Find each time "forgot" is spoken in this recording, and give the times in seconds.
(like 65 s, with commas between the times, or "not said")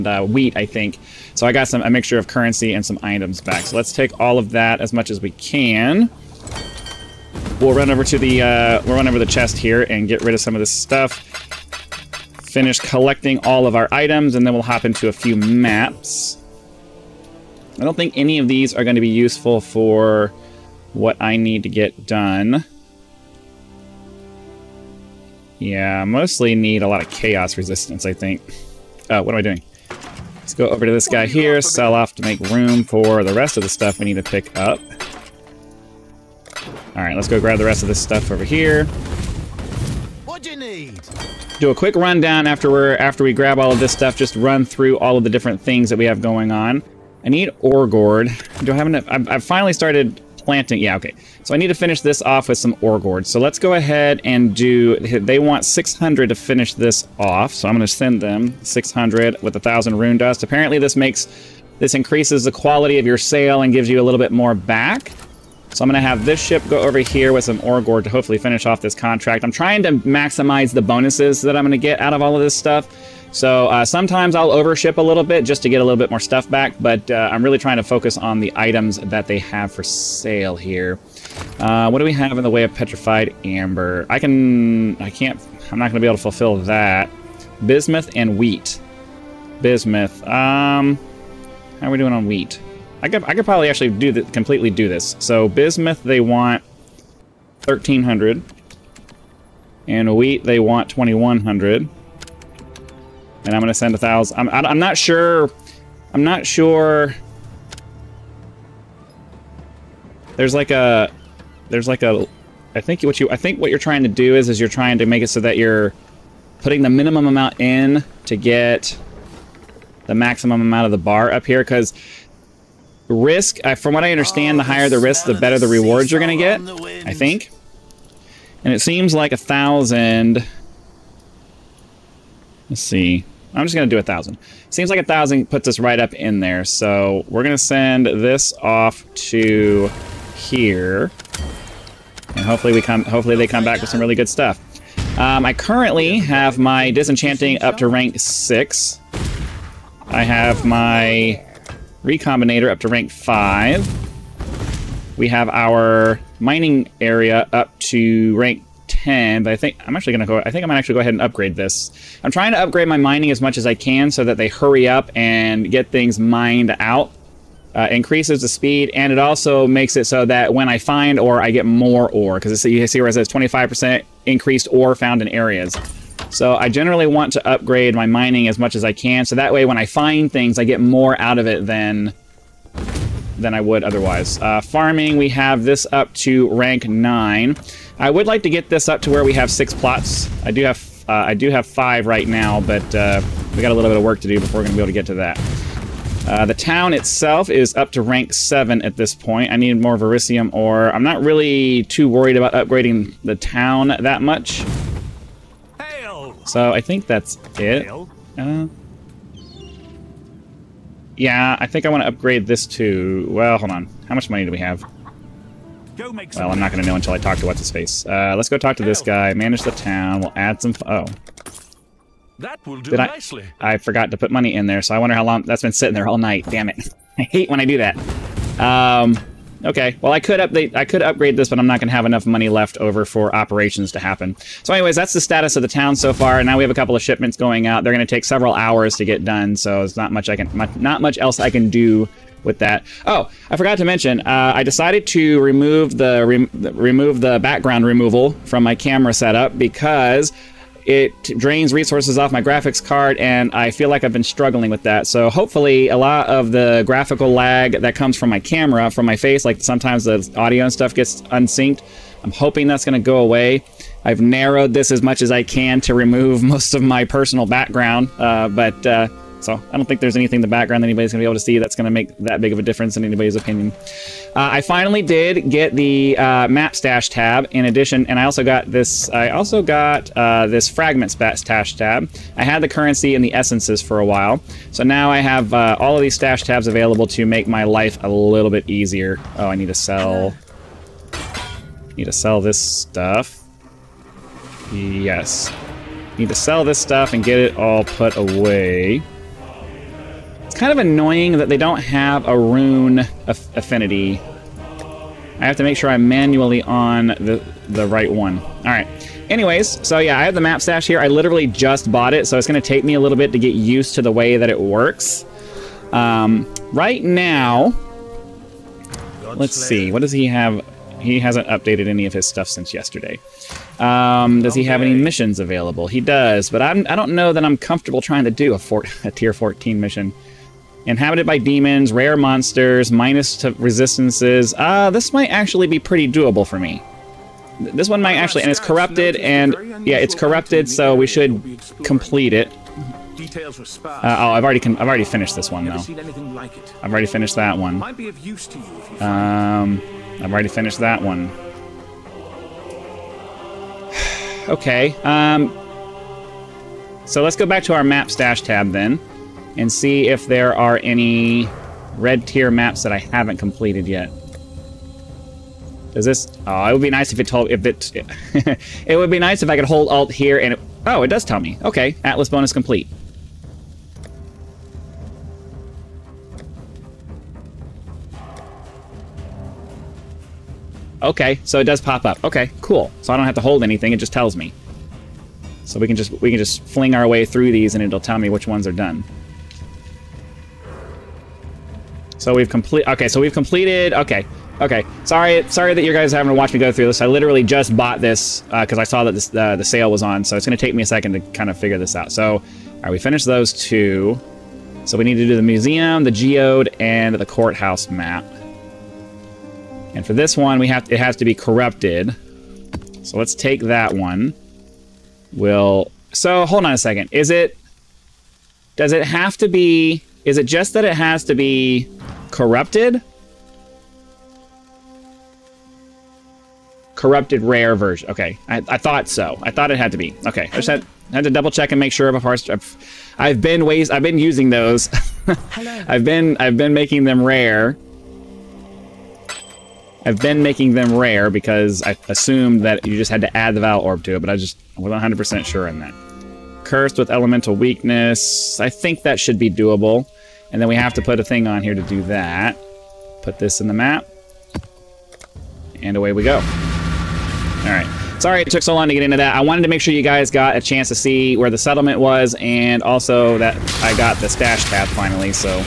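223 s, 243 s.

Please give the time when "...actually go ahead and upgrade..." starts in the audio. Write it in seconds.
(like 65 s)
160 s.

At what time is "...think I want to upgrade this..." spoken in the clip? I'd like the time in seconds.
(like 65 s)
211 s.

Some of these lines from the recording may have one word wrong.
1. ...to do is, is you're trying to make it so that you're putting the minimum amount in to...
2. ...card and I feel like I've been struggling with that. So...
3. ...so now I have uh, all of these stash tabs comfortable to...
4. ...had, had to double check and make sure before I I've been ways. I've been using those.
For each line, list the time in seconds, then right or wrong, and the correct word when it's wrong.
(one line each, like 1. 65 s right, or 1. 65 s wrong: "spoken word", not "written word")
1. 114 s right
2. 252 s right
3. 284 s wrong: "available", not "comfortable"
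4. 430 s right.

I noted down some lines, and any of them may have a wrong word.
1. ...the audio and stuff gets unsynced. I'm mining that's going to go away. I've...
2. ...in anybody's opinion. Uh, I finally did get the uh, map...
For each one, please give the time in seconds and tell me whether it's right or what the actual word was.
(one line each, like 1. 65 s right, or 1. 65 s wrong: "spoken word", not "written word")
1. 260 s wrong: "hoping", not "mining"
2. 272 s right.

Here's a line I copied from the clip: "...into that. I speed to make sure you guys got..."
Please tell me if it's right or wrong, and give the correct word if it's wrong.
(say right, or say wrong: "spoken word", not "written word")
wrong: "wanted", not "speed".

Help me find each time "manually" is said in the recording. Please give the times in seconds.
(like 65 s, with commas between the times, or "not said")
306 s.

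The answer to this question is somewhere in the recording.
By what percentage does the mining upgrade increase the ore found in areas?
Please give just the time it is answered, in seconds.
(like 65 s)
173 s.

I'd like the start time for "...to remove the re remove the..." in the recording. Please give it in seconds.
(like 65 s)
245 s.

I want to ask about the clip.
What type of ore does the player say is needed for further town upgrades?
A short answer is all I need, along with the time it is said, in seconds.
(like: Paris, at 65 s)
Verisium ore, at 199 s.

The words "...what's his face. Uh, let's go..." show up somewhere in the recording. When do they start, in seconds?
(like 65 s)
217 s.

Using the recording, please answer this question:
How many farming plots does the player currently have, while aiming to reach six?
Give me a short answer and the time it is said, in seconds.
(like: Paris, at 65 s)
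5, at 191 s.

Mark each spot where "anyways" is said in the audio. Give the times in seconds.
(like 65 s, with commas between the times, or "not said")
234 s, 309 s.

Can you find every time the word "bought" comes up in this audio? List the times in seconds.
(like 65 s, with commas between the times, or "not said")
311 s, 397 s.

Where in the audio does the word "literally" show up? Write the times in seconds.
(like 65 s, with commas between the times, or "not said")
311 s, 397 s.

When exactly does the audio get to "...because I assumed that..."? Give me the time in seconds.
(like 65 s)
441 s.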